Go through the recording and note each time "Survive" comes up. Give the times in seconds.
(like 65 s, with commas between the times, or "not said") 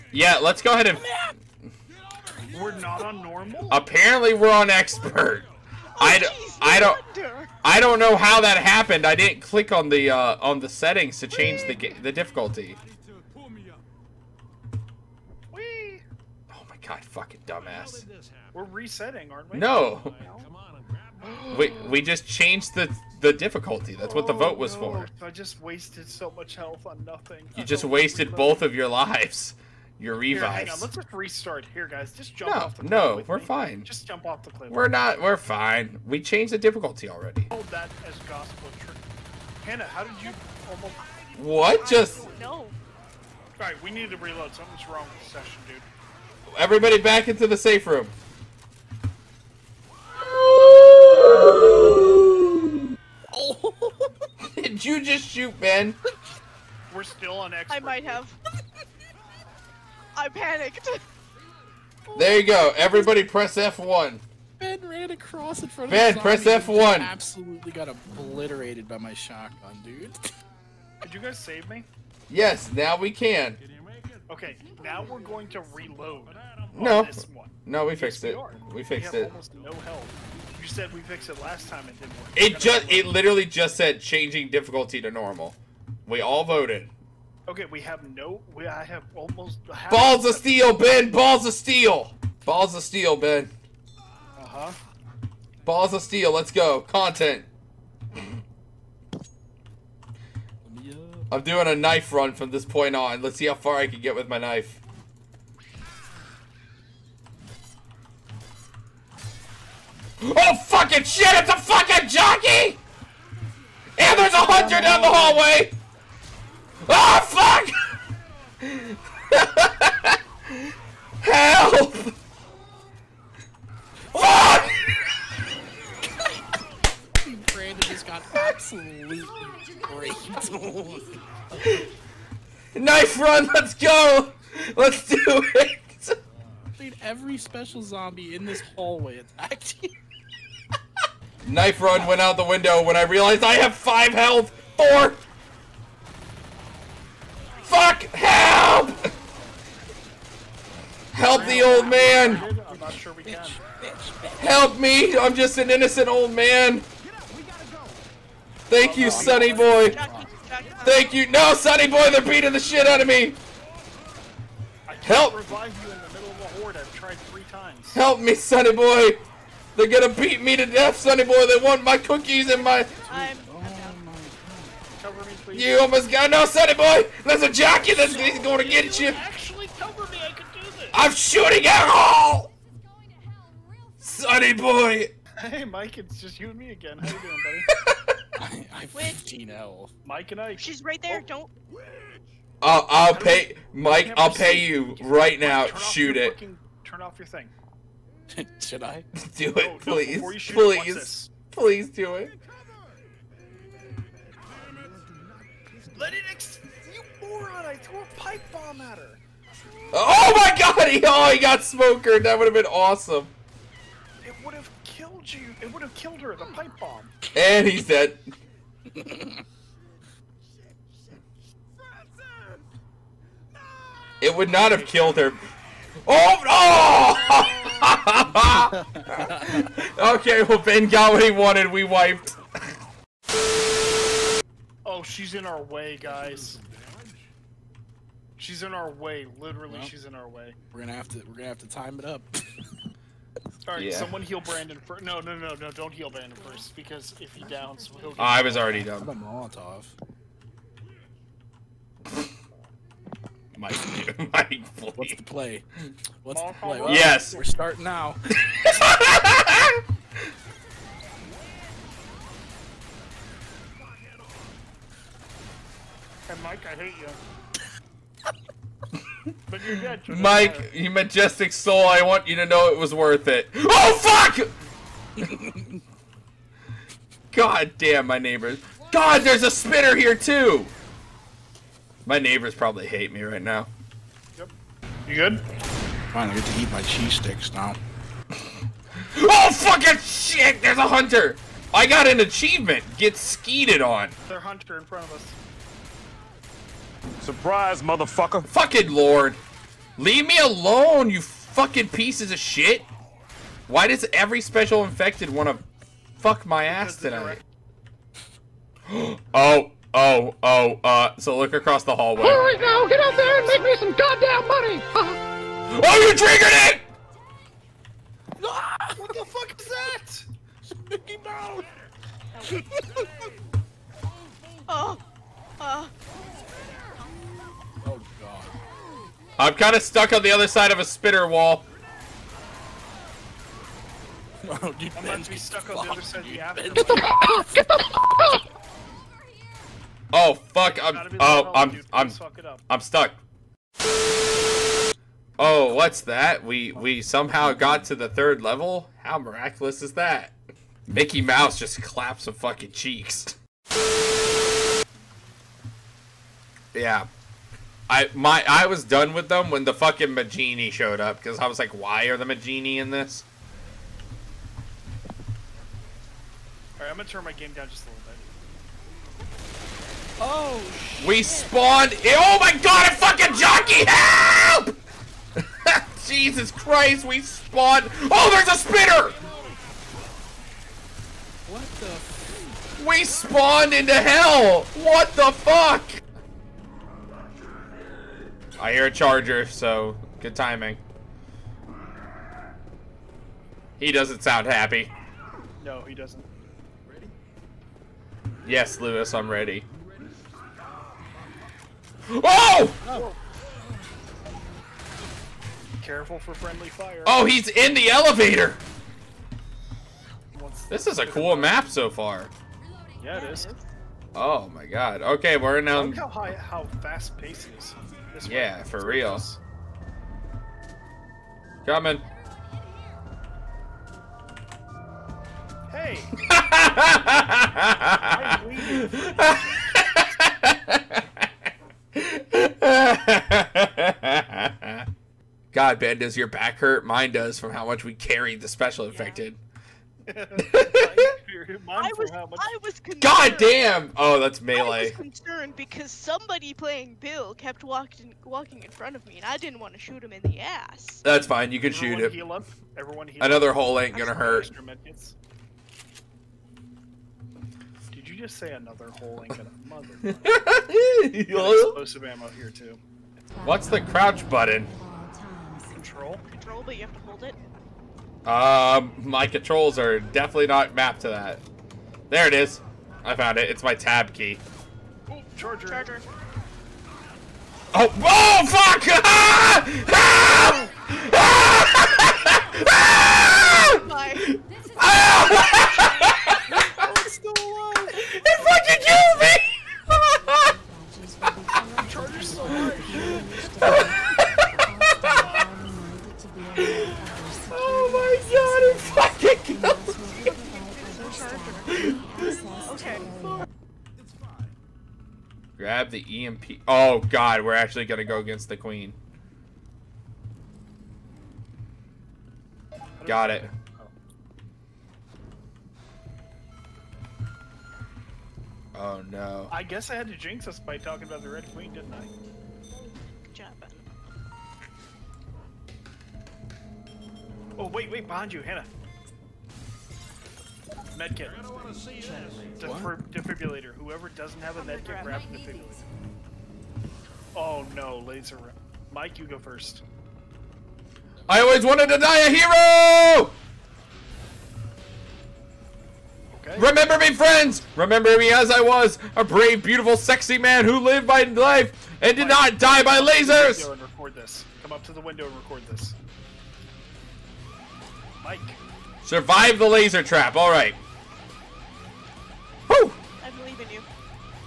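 559 s.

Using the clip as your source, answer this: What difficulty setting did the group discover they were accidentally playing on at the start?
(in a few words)
expert.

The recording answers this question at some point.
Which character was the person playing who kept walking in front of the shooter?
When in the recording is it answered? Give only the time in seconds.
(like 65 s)
447 s.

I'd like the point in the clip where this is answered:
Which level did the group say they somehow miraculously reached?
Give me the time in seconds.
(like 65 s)
348 s.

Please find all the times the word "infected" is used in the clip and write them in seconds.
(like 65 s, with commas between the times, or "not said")
304 s, 438 s.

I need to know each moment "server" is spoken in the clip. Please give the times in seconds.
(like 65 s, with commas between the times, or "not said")
not said.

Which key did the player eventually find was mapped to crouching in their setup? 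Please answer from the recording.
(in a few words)
tab key.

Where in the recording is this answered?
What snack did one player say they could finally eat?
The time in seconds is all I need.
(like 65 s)
286 s.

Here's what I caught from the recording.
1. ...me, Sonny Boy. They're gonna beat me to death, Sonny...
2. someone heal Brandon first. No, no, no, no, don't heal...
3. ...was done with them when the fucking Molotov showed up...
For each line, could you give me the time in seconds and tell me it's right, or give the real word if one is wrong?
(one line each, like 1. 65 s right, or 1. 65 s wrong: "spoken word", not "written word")
1. 168 s right
2. 243 s right
3. 358 s wrong: "Magini", not "Molotov".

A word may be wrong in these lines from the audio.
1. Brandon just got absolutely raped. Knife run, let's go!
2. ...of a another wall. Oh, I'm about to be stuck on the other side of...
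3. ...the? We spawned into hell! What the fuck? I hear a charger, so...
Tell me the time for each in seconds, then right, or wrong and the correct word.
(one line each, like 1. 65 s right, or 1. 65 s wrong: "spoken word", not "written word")
1. 127 s right
2. 330 s wrong: "spitter", not "another"
3. 381 s right.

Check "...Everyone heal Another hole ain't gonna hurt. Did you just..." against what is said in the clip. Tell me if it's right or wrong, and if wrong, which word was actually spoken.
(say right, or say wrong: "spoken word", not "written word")
right.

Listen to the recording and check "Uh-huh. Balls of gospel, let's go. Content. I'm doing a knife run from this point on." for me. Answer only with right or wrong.
wrong.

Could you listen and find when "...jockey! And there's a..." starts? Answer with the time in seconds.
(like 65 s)
112 s.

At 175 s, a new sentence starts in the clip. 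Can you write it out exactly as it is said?
you almost got no, Sonny Boy.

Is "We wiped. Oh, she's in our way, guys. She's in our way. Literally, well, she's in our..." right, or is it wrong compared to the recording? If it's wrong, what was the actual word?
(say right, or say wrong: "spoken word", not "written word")
right.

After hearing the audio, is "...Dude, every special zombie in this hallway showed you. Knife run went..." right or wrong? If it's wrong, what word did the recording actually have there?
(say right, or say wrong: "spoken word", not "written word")
wrong: "attacked", not "showed".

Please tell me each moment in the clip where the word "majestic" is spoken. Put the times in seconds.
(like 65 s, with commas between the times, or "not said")
270 s.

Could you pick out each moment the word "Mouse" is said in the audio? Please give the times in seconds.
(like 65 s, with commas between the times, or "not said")
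321 s, 351 s.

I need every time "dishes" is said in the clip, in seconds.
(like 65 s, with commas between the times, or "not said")
not said.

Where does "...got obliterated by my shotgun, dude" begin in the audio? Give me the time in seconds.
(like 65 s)
67 s.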